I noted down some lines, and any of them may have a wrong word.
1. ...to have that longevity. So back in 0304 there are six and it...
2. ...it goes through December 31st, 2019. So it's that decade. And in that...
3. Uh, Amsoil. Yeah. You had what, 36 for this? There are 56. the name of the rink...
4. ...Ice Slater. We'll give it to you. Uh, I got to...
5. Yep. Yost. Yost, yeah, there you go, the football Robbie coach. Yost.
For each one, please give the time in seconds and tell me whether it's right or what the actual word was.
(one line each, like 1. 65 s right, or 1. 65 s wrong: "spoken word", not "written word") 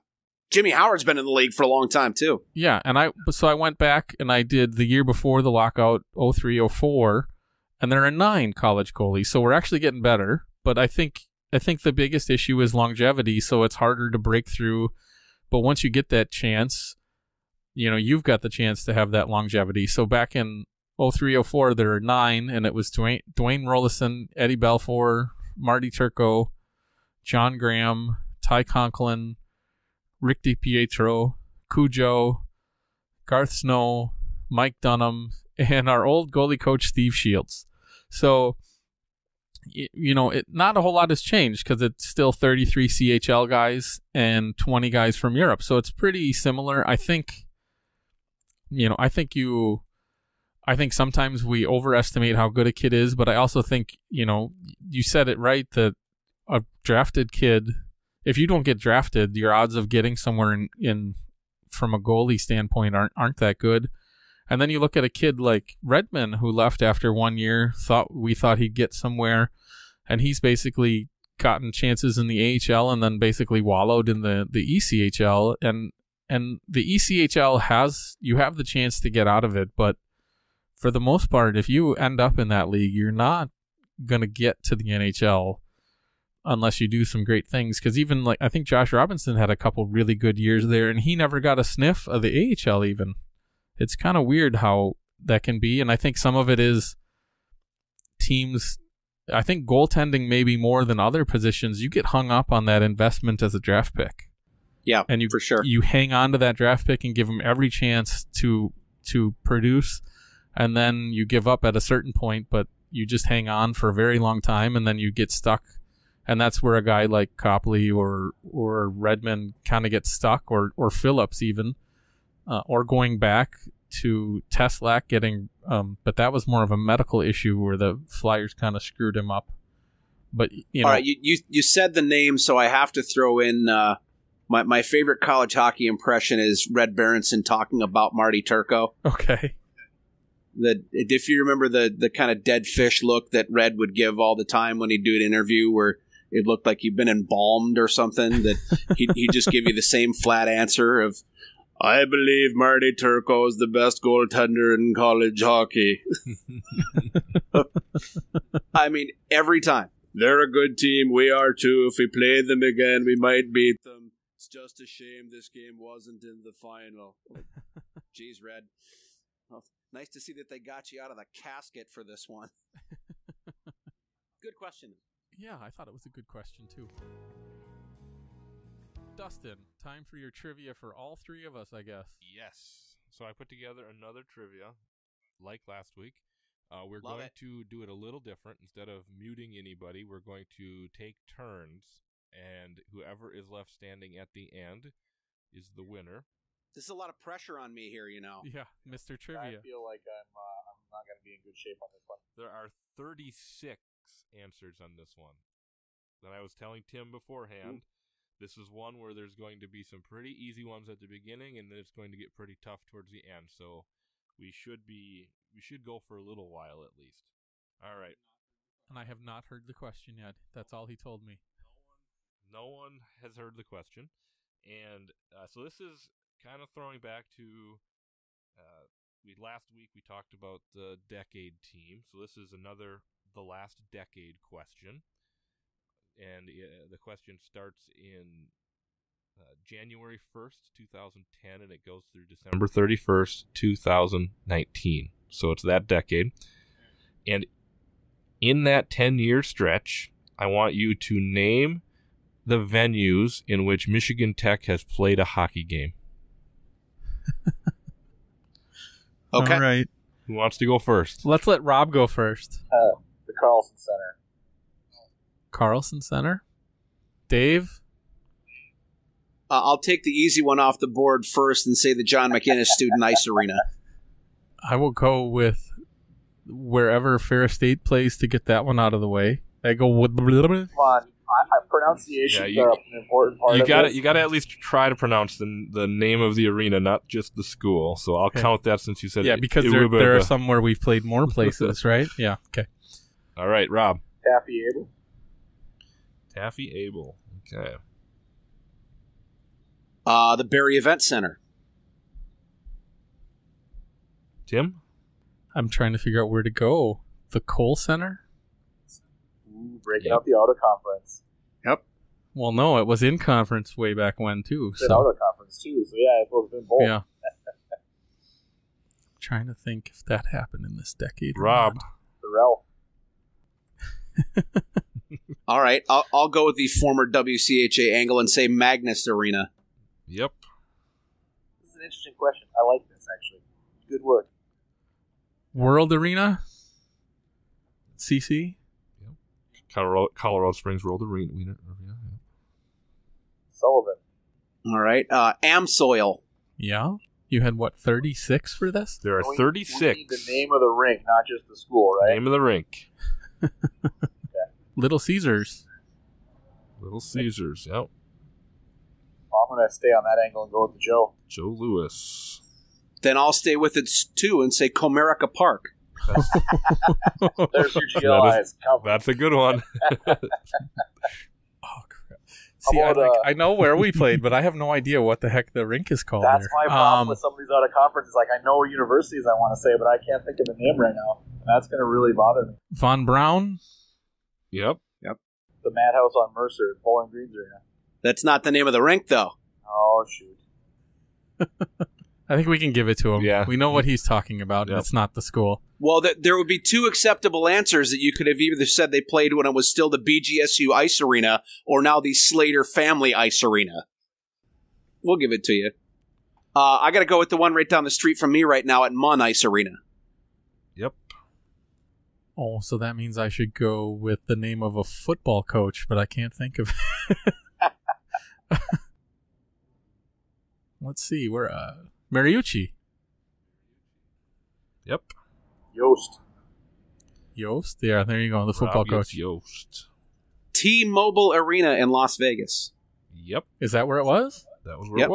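1. 18 s wrong: "nine", not "six"
2. 241 s right
3. 345 s wrong: "36", not "56"
4. 403 s wrong: "Arena", not "Slater"
5. 424 s right.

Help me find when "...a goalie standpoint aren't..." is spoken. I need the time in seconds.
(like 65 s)
61 s.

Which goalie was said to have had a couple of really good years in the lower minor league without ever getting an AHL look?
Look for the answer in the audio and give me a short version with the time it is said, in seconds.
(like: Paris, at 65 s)
Josh Robinson, at 88 s.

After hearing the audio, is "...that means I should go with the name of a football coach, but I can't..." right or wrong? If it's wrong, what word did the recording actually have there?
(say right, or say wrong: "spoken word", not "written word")
right.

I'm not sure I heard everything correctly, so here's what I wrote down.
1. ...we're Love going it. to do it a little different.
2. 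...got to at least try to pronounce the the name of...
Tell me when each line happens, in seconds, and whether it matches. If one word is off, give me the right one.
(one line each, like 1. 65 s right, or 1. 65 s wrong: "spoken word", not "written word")
1. 186 s right
2. 284 s right.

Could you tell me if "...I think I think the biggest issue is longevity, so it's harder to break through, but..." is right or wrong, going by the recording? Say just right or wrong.
right.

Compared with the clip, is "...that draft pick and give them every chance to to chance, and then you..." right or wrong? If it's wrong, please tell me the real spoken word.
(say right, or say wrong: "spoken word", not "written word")
wrong: "produce", not "chance".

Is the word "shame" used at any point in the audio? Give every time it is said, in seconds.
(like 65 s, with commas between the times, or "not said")
164 s.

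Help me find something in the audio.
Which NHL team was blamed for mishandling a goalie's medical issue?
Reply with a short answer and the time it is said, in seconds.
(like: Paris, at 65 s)
the Flyers, at 127 s.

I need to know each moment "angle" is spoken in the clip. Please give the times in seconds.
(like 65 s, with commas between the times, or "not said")
327 s, 360 s.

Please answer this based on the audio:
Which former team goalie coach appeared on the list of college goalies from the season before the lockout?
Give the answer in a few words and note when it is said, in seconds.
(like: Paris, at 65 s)
Steve Shields, at 36 s.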